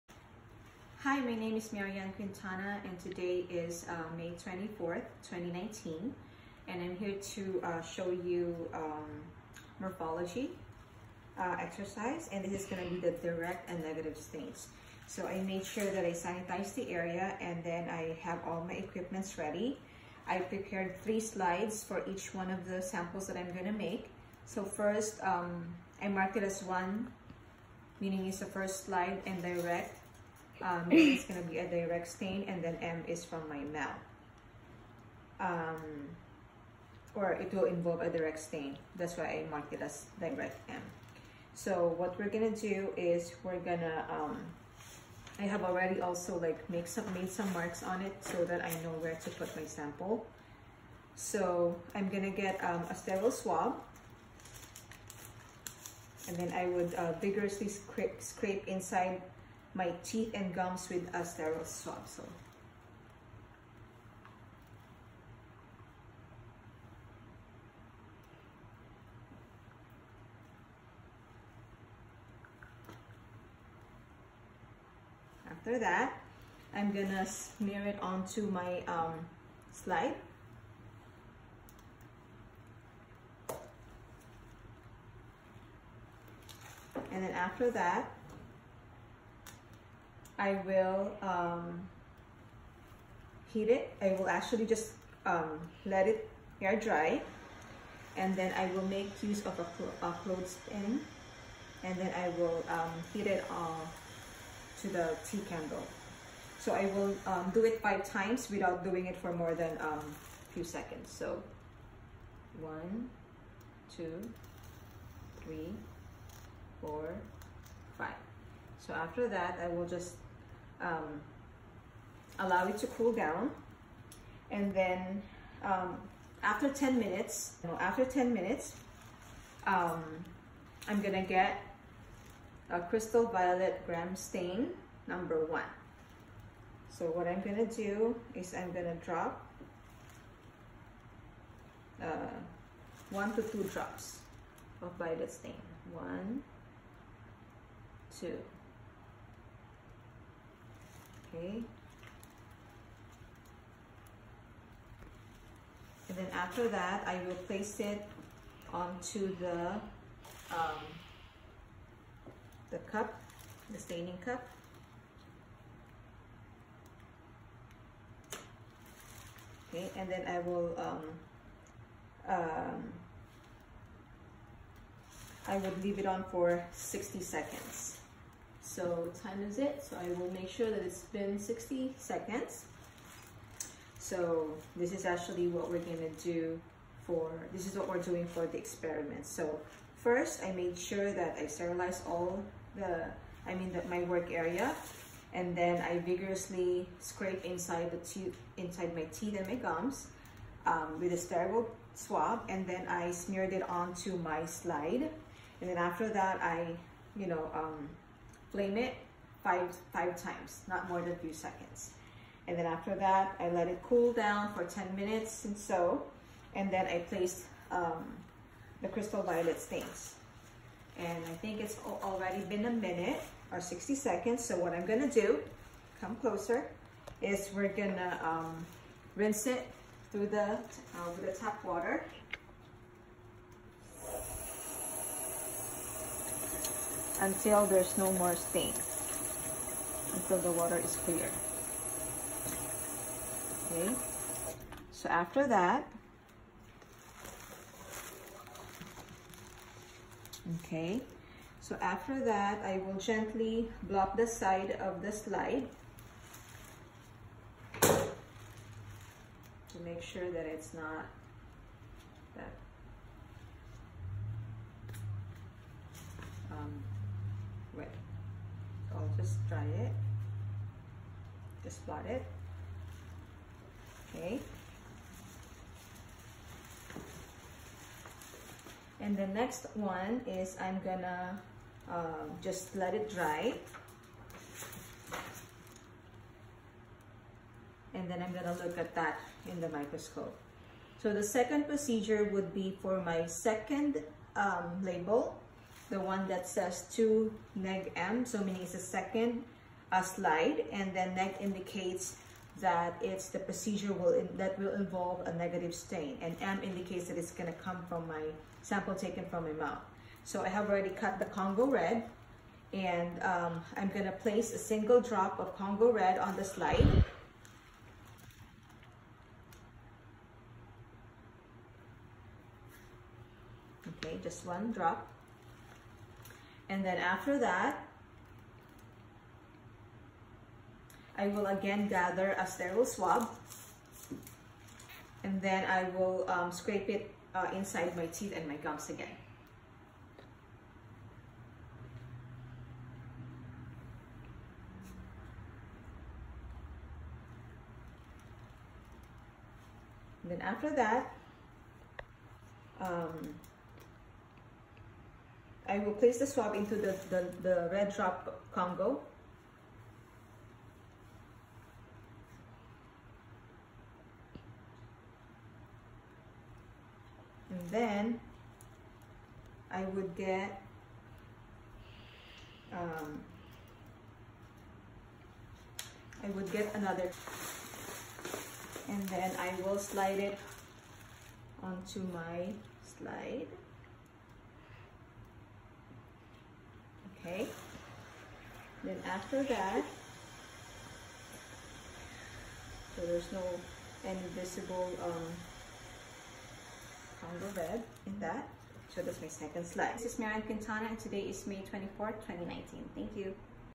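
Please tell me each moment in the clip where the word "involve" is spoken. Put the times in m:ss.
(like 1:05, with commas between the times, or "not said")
0:37, 5:04.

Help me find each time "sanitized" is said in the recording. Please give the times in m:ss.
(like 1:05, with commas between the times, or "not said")
0:16.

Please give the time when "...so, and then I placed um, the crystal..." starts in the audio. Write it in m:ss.
3:35.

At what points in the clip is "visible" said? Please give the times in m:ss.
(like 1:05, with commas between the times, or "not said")
6:34.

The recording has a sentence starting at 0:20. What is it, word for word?
I prepared three slides for each one of the samples that I'm going to make.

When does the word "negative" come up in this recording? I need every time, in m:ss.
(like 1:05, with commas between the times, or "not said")
0:13, 5:05.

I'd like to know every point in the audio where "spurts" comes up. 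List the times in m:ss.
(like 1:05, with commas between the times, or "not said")
not said.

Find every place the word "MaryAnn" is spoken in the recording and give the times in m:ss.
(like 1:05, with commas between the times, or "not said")
0:01, 6:40.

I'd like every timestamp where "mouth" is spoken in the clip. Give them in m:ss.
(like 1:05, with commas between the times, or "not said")
0:33, 5:09.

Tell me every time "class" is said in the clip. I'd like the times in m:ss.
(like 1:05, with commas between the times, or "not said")
not said.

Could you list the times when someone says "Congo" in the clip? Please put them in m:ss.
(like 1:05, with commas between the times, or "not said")
5:11, 5:15, 5:58.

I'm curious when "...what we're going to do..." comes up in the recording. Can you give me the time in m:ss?
0:41.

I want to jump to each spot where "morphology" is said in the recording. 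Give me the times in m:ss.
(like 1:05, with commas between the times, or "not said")
0:09.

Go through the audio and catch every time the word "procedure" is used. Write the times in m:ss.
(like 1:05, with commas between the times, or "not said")
4:51, 5:03.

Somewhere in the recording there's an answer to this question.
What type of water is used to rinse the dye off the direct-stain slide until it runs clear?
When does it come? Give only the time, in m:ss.
3:51.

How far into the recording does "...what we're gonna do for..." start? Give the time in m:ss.
3:05.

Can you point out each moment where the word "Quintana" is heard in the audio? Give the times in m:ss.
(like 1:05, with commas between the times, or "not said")
0:02, 6:40.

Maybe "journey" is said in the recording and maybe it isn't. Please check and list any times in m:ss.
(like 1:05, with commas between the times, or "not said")
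not said.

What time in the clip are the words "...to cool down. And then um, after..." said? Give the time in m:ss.
2:02.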